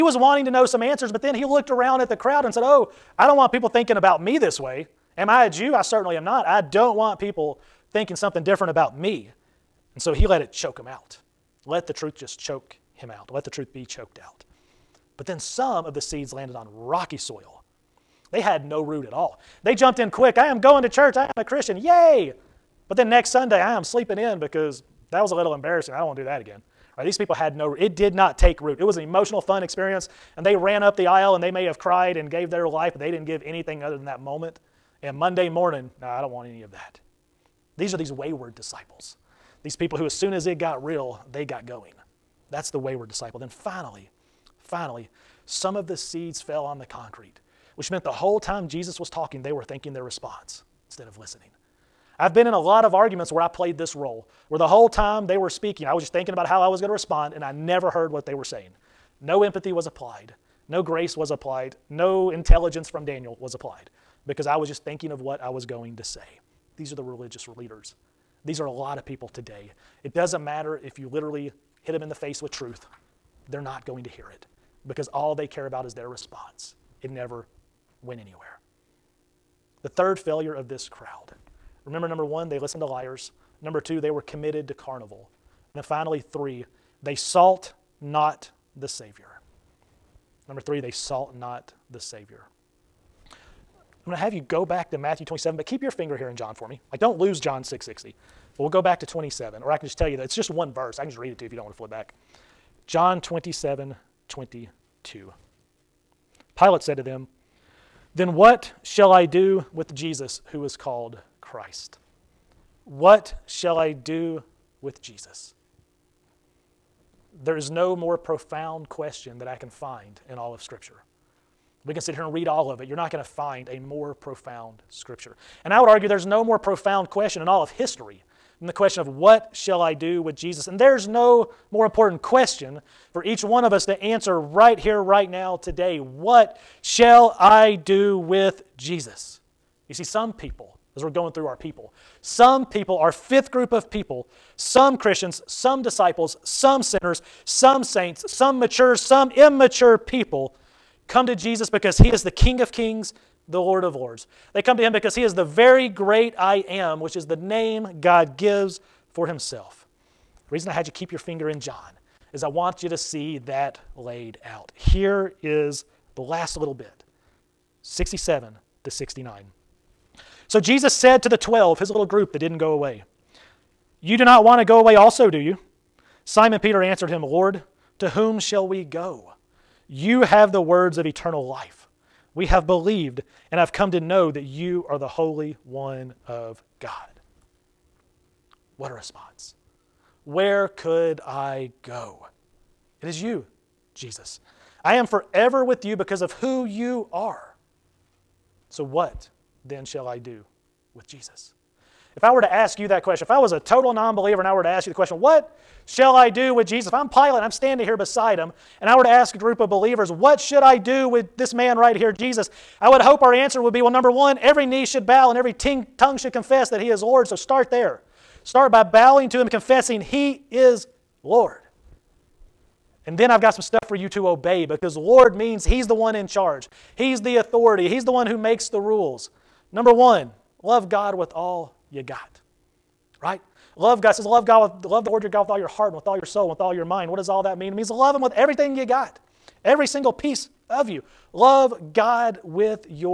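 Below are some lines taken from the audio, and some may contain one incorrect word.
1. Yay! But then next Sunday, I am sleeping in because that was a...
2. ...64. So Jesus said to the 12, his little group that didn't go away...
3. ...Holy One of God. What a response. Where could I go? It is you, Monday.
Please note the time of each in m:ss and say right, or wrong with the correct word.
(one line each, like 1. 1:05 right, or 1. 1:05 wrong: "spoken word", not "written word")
1. 0:21 right
2. 2:48 wrong: "69", not "64"
3. 3:05 wrong: "Jesus", not "Monday".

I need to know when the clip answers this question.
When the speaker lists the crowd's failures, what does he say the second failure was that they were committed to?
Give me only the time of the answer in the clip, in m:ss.
1:24.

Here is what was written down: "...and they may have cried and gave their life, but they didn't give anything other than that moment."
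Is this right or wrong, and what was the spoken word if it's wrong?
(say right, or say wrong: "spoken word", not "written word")
right.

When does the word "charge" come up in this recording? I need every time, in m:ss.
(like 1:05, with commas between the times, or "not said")
3:46.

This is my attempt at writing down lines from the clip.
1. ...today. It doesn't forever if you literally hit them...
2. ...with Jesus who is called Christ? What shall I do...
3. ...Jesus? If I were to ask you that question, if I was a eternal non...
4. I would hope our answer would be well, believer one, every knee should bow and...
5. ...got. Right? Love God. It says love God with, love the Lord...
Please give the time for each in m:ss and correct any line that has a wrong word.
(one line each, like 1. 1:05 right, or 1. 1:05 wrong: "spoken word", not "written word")
1. 1:09 wrong: "matter", not "forever"
2. 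1:49 right
3. 3:21 wrong: "total", not "eternal"
4. 3:32 wrong: "number", not "believer"
5. 3:52 right.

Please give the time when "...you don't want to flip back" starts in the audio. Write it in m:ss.
1:41.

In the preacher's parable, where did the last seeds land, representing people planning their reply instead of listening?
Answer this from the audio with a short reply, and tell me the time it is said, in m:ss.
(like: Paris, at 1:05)
Concrete, at 0:46.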